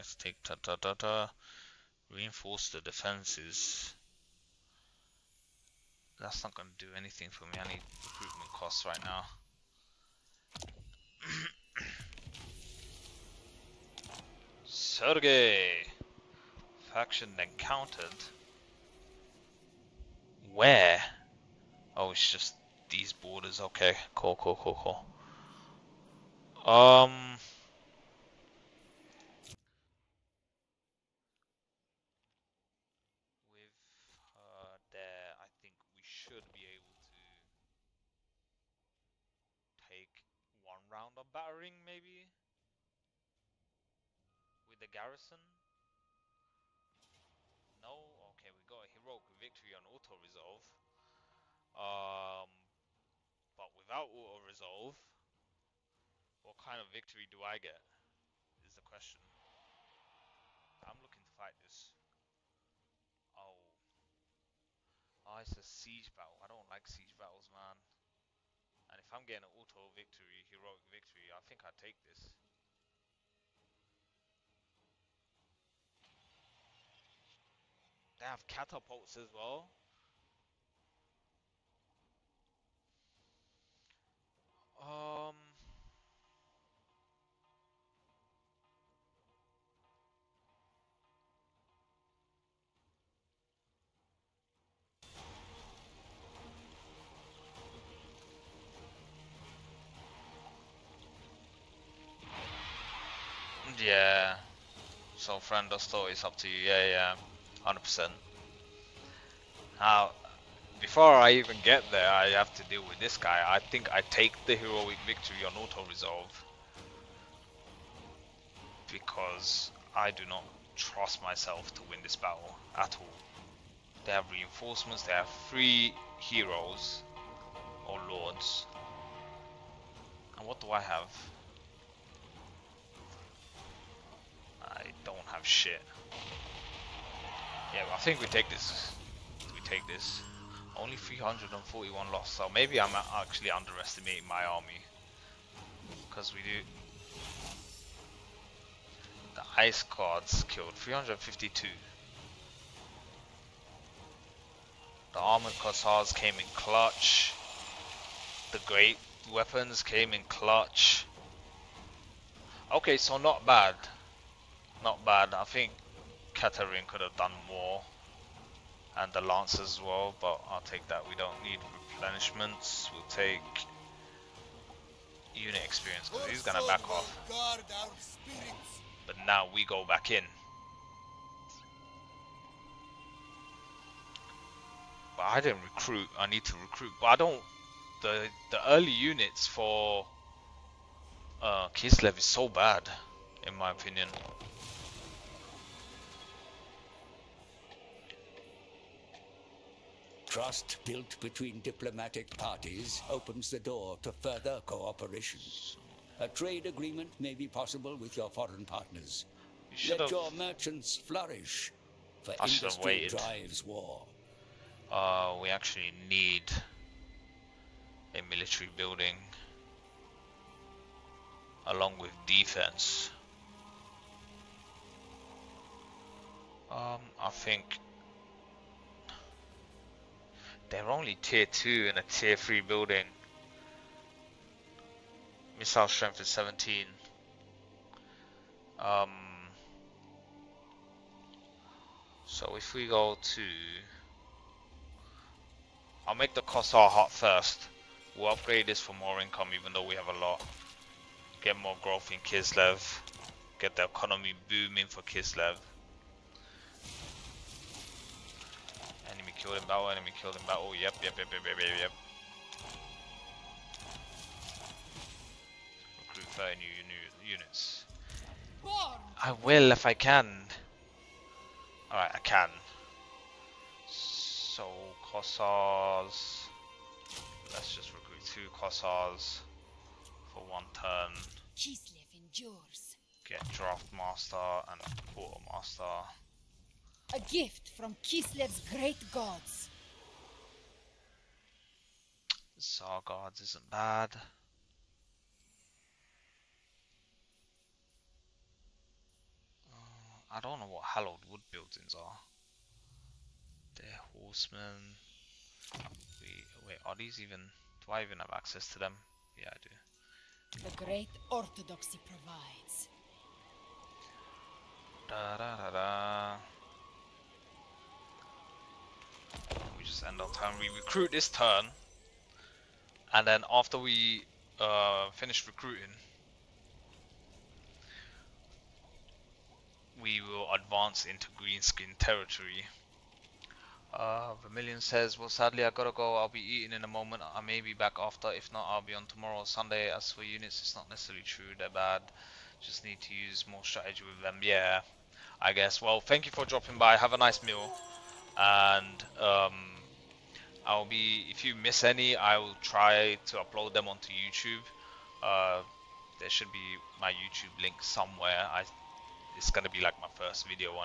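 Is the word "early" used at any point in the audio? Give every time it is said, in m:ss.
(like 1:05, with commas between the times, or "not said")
3:08.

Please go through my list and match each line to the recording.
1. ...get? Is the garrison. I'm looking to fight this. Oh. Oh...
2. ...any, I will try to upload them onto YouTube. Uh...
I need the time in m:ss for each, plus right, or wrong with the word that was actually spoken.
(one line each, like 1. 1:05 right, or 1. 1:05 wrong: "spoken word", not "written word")
1. 0:57 wrong: "question", not "garrison"
2. 5:51 right.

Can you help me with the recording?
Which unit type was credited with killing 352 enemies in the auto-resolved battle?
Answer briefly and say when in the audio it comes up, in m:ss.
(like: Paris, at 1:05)
Ice guards, at 2:29.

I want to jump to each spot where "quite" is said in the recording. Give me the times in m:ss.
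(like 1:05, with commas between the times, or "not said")
not said.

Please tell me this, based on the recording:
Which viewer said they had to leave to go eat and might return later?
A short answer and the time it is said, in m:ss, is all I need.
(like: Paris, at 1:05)
Vermilion, at 5:34.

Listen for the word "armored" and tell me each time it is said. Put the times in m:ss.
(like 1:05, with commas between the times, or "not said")
2:35.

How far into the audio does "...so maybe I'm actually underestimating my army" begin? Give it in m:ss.
2:22.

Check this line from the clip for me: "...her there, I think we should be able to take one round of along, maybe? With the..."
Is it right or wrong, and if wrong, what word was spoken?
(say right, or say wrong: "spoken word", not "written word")
wrong: "battering", not "along".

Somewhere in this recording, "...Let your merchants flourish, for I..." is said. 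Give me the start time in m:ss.
3:29.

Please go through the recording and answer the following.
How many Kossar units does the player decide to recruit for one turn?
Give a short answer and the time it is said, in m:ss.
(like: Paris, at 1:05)
Two, at 4:38.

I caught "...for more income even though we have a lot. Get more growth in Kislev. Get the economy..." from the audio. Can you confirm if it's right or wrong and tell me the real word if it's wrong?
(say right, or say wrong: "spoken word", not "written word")
right.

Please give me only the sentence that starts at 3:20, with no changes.
Trust built between diplomatic parties opens the door to further cooperation.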